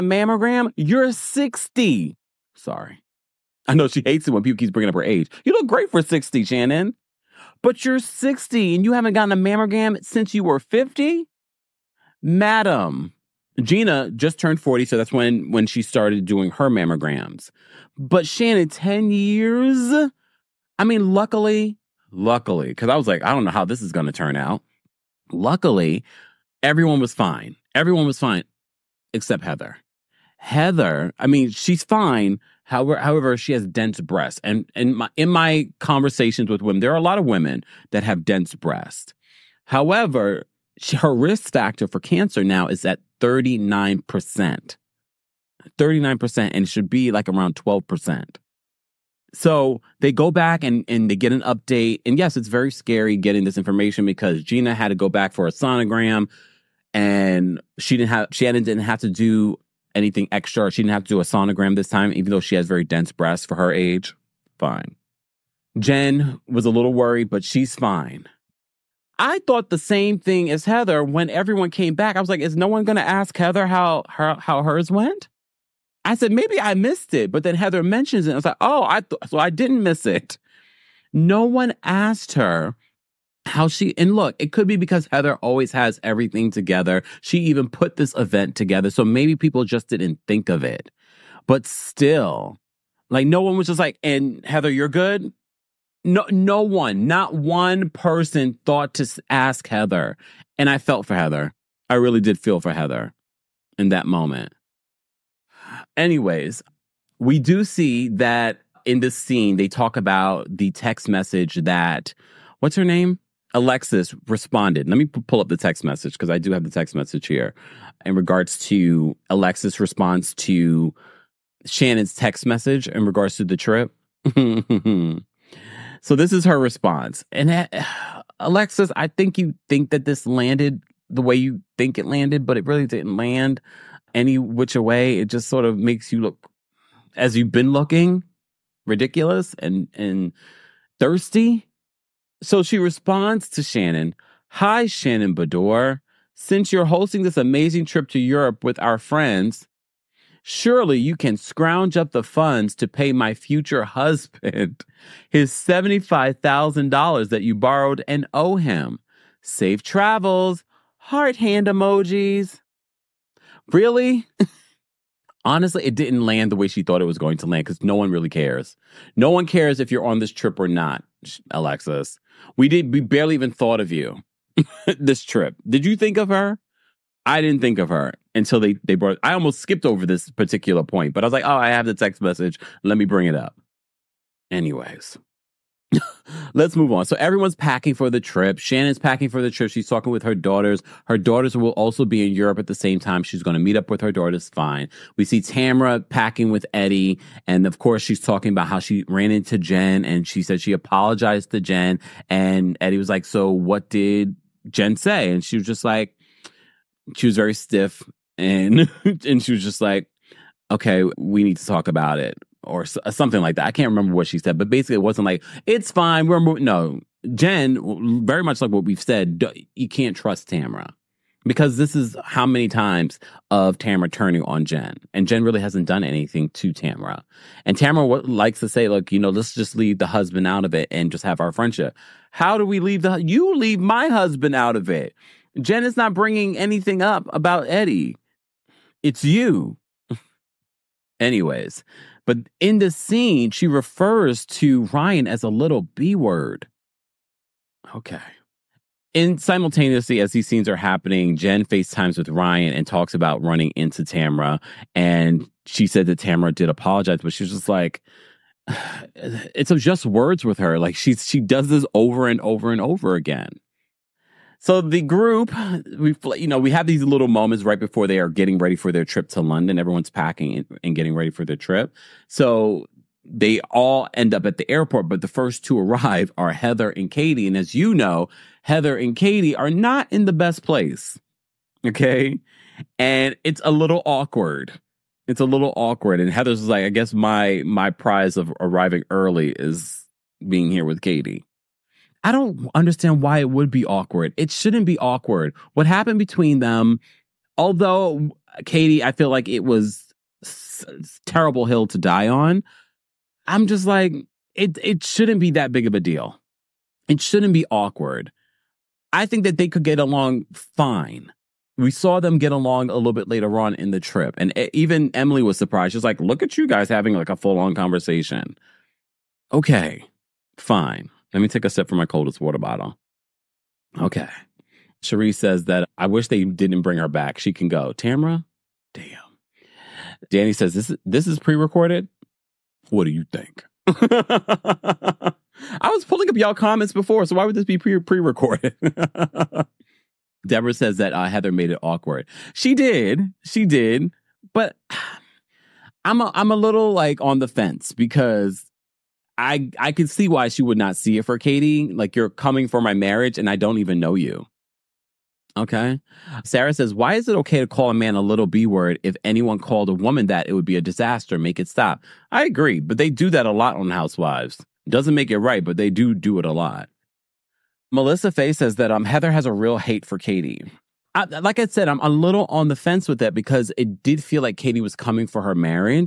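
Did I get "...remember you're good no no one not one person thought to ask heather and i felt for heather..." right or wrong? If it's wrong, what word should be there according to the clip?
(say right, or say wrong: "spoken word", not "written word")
wrong: "heather", not "remember".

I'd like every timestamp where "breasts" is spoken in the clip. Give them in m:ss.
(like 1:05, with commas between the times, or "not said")
0:33, 0:38, 1:03.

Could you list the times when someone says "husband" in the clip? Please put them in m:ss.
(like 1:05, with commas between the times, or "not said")
2:33, 3:50, 3:54.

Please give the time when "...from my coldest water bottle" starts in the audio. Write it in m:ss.
5:21.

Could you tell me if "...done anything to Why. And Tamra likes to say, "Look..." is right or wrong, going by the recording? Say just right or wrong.
wrong.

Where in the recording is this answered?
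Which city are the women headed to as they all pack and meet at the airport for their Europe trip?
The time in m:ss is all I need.
4:29.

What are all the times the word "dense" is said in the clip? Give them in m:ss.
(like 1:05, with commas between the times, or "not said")
0:33, 0:38, 1:02.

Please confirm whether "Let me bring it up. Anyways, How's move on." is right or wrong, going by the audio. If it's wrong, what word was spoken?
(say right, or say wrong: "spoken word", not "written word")
wrong: "Let", not "How".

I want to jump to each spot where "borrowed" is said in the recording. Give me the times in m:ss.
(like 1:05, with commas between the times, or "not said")
2:37.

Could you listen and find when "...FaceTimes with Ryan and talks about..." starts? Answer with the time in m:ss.
4:11.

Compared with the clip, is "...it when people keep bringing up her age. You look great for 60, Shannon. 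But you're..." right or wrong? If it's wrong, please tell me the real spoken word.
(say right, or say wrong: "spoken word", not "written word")
right.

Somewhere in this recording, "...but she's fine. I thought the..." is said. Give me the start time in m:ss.
1:07.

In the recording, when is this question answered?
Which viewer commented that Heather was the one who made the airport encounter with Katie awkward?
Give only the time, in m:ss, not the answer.
5:40.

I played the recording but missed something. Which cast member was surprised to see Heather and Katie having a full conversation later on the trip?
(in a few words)
Emily.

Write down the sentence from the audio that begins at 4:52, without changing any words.
I don't understand why it would be awkward.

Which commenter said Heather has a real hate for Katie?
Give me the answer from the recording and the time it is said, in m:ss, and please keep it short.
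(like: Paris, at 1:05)
Melissa Faye, at 6:07.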